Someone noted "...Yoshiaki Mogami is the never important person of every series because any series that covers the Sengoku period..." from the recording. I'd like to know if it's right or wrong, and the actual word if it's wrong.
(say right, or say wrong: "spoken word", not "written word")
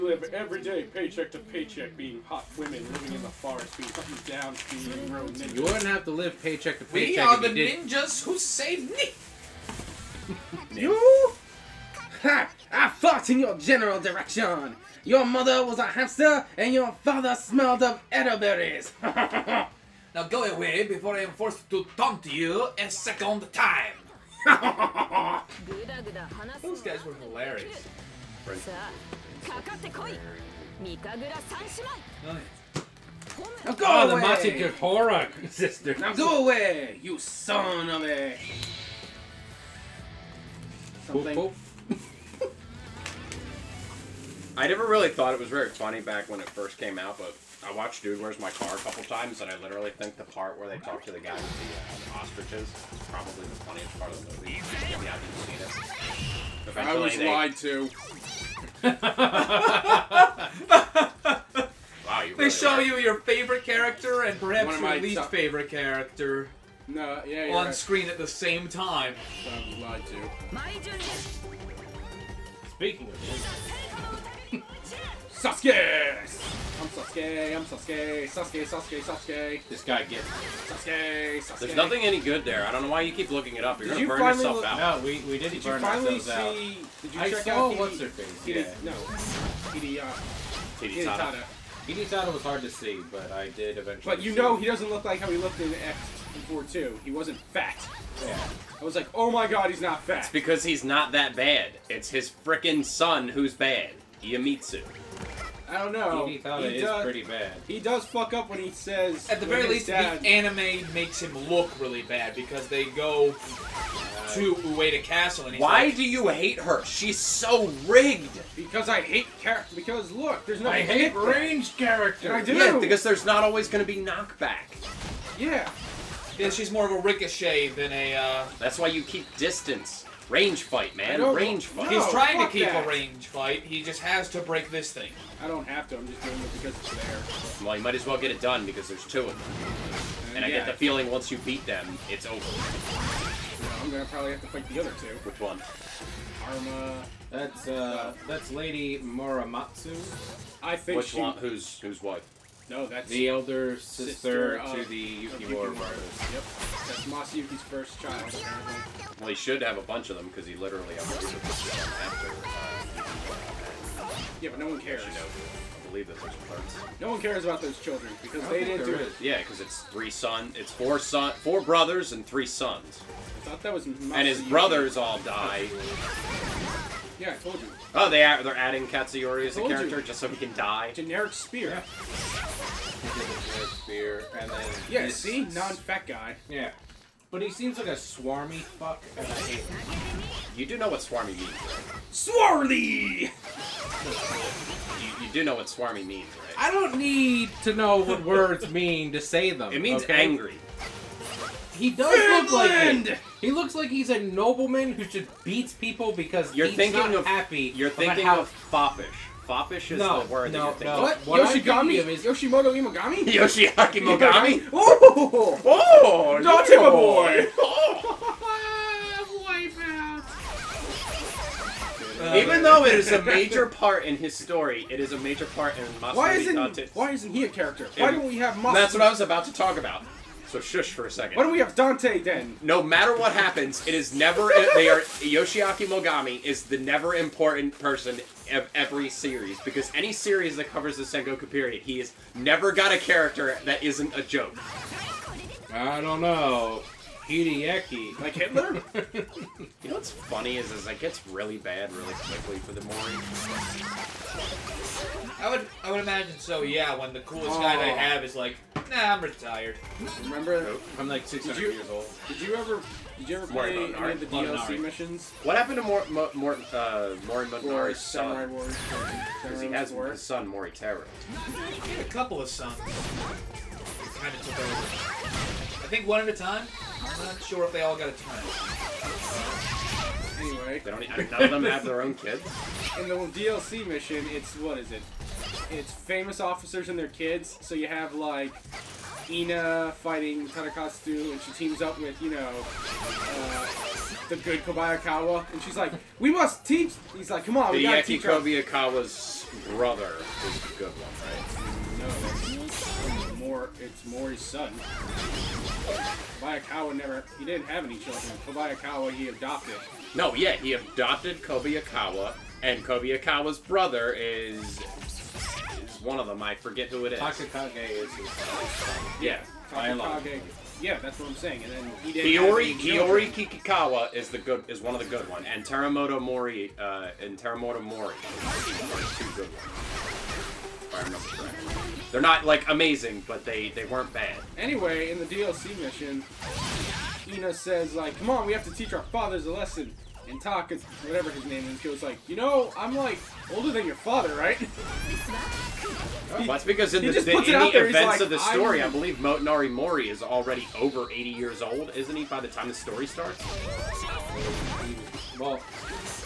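right.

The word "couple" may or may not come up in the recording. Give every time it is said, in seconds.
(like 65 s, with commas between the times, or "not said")
48 s, 272 s.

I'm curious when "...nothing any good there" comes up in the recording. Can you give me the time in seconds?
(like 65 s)
81 s.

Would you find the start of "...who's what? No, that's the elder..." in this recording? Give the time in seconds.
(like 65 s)
151 s.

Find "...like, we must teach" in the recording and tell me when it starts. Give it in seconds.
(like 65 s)
295 s.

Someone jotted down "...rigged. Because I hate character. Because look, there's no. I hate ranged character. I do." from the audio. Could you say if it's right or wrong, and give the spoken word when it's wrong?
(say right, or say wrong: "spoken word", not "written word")
right.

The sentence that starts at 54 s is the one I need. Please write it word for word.
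Yeah, I not Eventually I was they...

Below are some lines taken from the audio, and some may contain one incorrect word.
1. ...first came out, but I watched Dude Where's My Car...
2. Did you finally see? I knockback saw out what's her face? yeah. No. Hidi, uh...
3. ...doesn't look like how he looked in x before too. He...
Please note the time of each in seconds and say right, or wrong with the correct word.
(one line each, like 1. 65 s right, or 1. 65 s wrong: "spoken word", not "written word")
1. 46 s right
2. 86 s wrong: "check", not "knockback"
3. 94 s right.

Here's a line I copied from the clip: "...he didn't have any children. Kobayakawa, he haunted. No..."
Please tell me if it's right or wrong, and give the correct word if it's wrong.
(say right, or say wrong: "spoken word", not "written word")
wrong: "adopted", not "haunted".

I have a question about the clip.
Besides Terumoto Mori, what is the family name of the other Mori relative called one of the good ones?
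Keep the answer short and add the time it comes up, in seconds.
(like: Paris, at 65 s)
Kikkawa, at 323 s.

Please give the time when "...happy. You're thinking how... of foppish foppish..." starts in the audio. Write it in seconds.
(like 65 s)
207 s.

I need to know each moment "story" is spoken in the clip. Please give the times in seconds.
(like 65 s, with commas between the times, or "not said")
224 s, 348 s, 352 s.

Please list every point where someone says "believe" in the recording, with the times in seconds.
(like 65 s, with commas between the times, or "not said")
165 s, 348 s.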